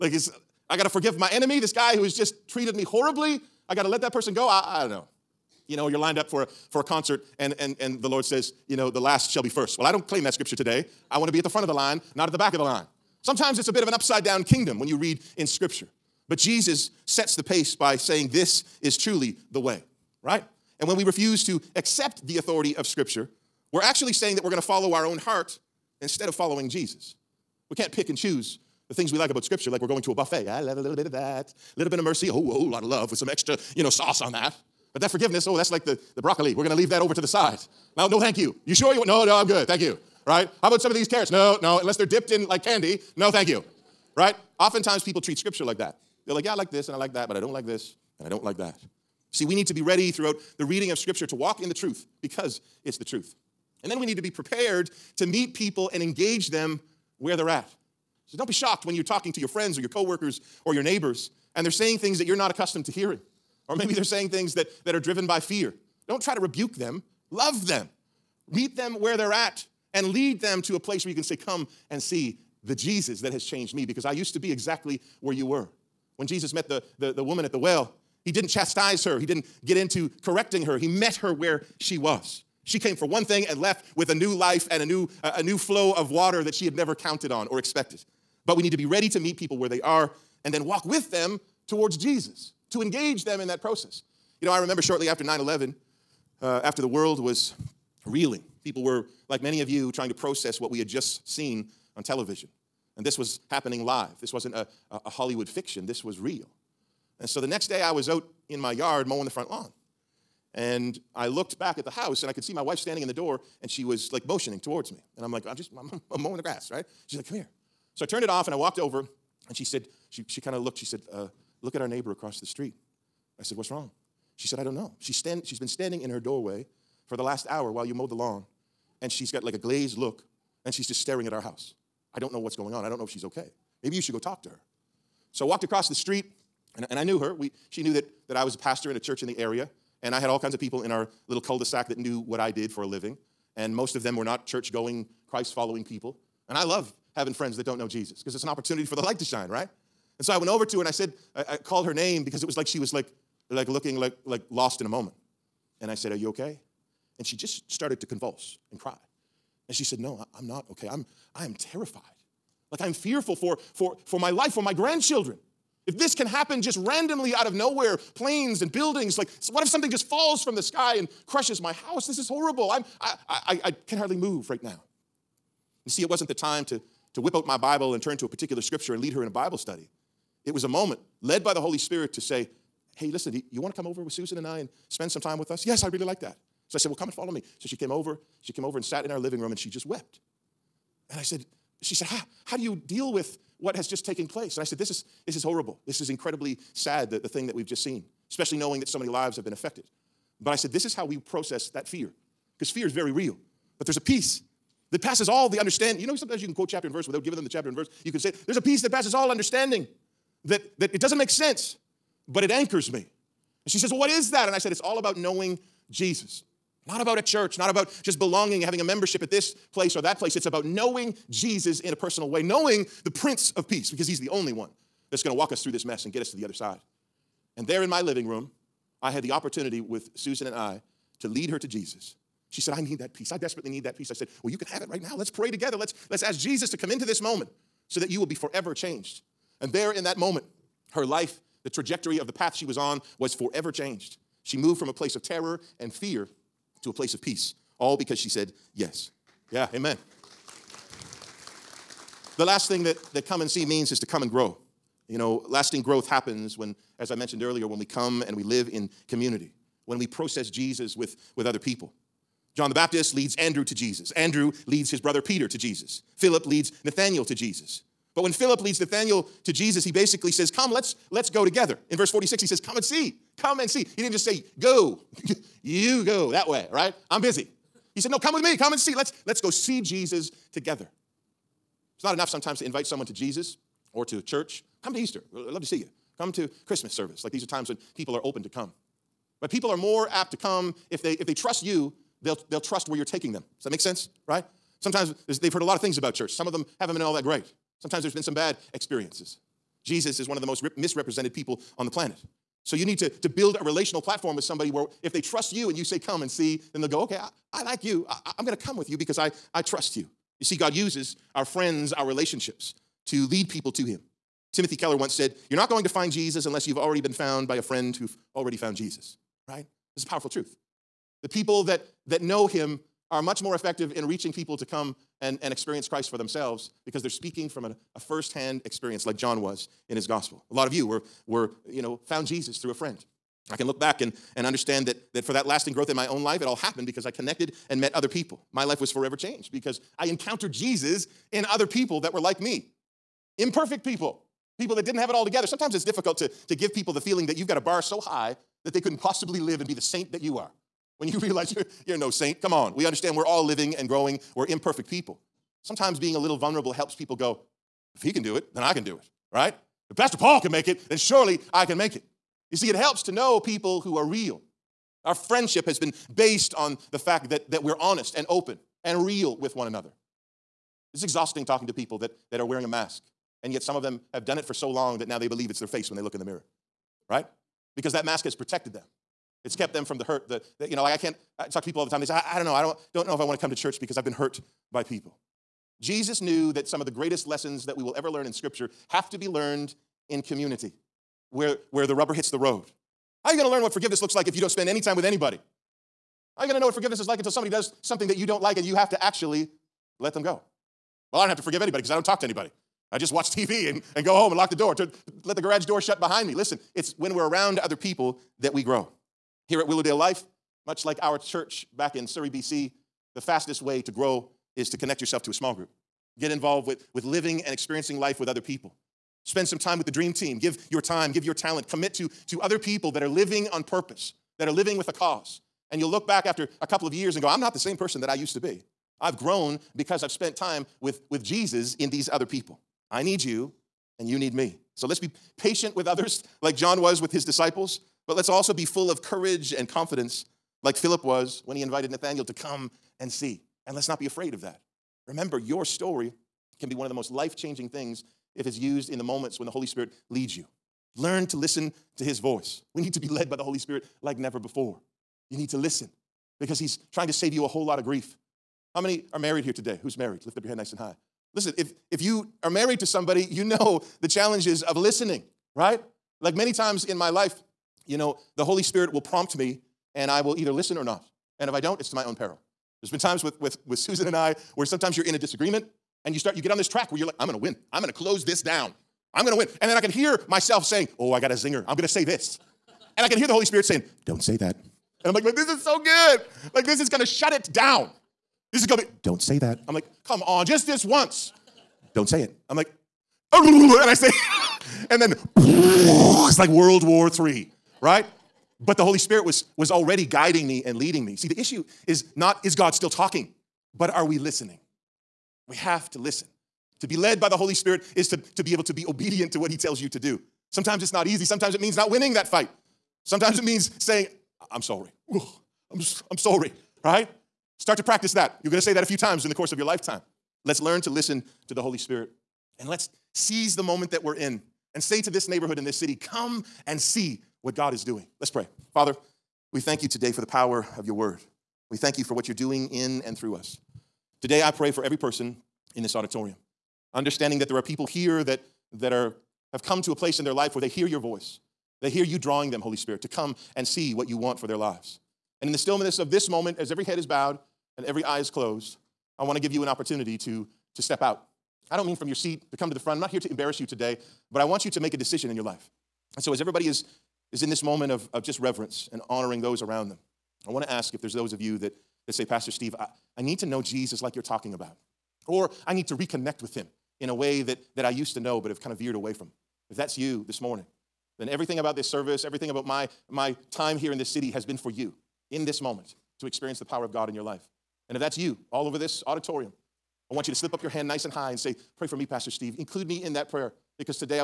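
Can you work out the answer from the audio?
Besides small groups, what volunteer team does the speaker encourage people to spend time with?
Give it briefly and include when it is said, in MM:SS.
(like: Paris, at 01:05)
the dream team, at 06:59.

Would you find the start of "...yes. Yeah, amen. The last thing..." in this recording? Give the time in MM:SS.
04:08.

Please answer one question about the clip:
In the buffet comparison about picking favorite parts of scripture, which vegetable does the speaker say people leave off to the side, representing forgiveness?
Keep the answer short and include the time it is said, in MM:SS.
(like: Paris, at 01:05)
broccoli, at 00:36.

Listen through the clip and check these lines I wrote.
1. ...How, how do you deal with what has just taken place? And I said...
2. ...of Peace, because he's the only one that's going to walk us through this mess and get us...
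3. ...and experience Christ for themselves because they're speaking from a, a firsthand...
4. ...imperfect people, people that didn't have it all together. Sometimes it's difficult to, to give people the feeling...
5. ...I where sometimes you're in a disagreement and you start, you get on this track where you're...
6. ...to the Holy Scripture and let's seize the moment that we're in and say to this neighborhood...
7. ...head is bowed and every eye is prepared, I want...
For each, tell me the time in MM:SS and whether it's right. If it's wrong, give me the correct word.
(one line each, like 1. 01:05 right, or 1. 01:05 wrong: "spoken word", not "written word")
1. 03:12 right
2. 03:43 right
3. 05:25 right
4. 05:43 right
5. 07:54 right
6. 08:41 wrong: "Spirit", not "Scripture"
7. 09:06 wrong: "closed", not "prepared".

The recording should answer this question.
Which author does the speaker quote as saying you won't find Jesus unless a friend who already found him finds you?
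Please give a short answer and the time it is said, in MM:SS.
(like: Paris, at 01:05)
Timothy Keller, at 05:14.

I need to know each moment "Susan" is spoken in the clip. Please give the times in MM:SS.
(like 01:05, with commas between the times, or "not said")
03:04, 03:50, 07:53.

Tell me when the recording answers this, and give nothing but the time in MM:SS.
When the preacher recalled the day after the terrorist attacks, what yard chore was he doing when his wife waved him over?
01:49.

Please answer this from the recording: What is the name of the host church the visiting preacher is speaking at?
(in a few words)
Willowdale Life.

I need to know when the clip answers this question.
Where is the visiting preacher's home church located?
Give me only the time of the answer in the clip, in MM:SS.
06:52.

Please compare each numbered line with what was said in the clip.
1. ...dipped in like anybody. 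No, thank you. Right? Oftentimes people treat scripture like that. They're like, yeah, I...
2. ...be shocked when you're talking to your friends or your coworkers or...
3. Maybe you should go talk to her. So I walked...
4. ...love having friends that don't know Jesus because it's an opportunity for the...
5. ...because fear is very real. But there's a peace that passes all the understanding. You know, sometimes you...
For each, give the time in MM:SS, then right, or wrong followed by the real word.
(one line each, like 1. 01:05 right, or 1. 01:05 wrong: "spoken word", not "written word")
1. 00:42 wrong: "candy", not "anybody"
2. 00:58 right
3. 02:13 right
4. 02:26 right
5. 03:22 right.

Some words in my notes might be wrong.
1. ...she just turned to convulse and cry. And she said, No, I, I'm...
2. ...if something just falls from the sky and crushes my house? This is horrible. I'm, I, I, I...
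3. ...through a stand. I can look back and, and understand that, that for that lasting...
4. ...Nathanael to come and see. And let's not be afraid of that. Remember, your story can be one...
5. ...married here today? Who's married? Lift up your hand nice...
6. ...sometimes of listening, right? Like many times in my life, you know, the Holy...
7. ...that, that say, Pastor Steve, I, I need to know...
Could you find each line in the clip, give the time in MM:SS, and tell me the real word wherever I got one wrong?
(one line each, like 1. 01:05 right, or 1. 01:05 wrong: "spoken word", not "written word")
1. 02:37 wrong: "started", not "turned"
2. 02:49 right
3. 05:32 wrong: "friend", not "stand"
4. 07:21 right
5. 07:39 right
6. 07:44 wrong: "challenges", not "sometimes"
7. 09:21 right.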